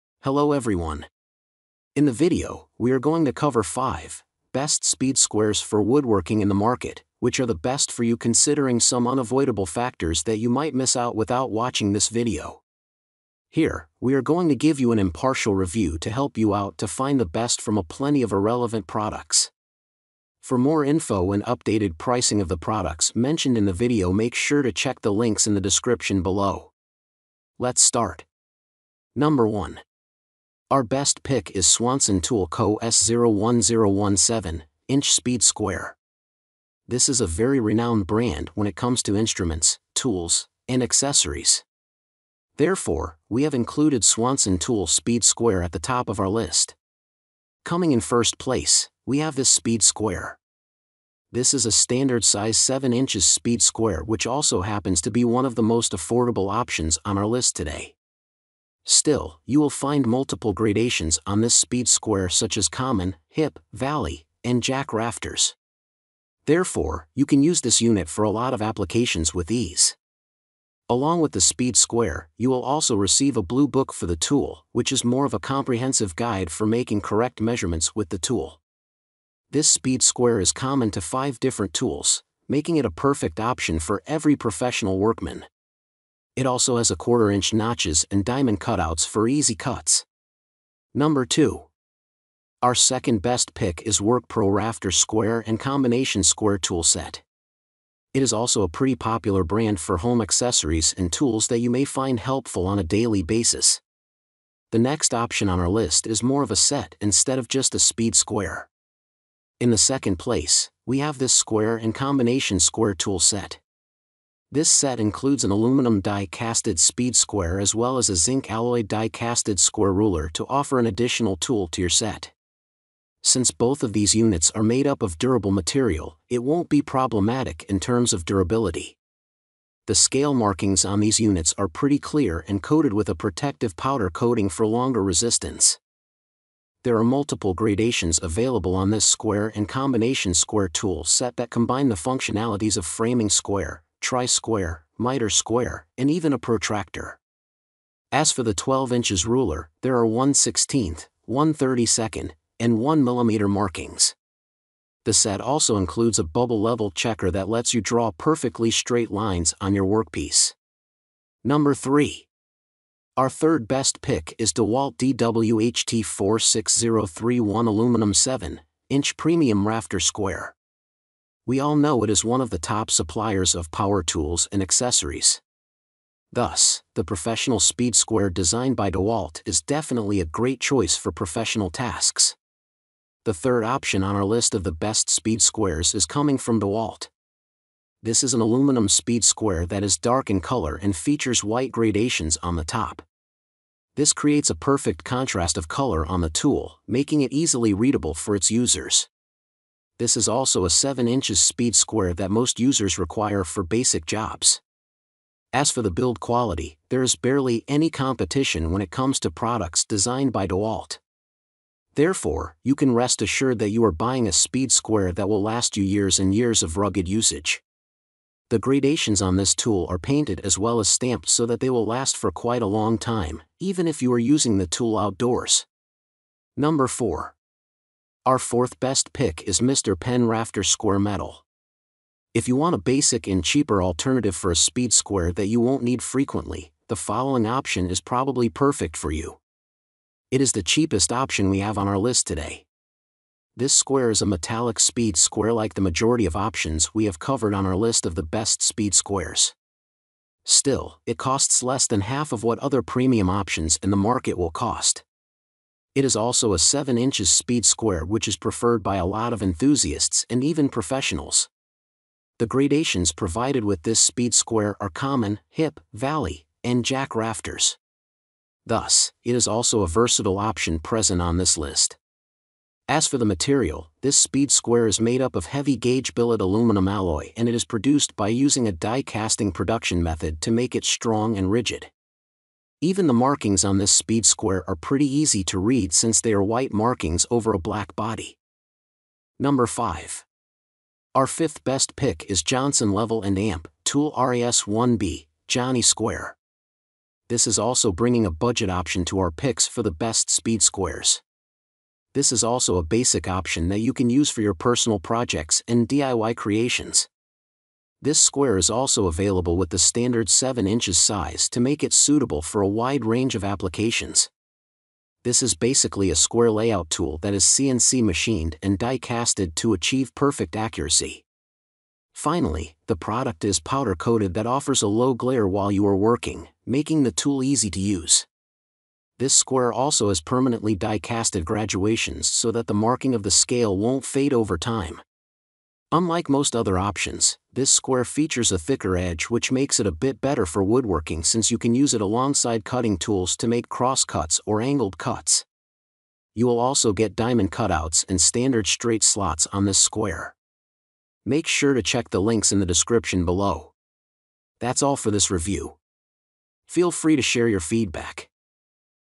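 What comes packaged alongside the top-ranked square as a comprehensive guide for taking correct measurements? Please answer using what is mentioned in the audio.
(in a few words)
a blue book.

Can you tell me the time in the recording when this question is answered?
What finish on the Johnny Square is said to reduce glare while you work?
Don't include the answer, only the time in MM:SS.
05:23.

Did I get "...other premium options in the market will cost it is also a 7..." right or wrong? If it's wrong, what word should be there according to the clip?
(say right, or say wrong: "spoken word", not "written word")
right.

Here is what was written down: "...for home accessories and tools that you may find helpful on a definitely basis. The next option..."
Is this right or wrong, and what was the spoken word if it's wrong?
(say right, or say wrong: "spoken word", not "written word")
wrong: "daily", not "definitely".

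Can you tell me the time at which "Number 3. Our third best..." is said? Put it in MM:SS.
02:41.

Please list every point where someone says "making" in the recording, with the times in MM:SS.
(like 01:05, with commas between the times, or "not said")
01:16, 01:22, 03:16, 05:26.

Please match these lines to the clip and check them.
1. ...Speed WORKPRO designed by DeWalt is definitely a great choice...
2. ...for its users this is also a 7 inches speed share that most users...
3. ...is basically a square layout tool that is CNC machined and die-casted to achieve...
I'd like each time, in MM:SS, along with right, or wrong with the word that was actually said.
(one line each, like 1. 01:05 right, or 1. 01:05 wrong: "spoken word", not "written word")
1. 02:57 wrong: "Square", not "WORKPRO"
2. 03:18 wrong: "square", not "share"
3. 05:15 right.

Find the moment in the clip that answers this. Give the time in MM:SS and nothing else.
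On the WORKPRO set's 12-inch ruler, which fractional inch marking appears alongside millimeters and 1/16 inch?
02:31.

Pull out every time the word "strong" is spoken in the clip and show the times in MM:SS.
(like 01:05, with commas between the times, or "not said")
04:40.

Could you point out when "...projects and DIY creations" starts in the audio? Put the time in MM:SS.
05:04.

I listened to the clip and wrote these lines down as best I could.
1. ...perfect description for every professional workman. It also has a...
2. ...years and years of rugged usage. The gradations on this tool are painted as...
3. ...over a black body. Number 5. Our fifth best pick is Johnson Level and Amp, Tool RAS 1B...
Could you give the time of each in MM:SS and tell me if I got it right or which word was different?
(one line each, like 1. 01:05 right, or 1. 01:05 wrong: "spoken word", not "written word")
1. 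01:22 wrong: "option", not "description"
2. 03:35 right
3. 04:47 right.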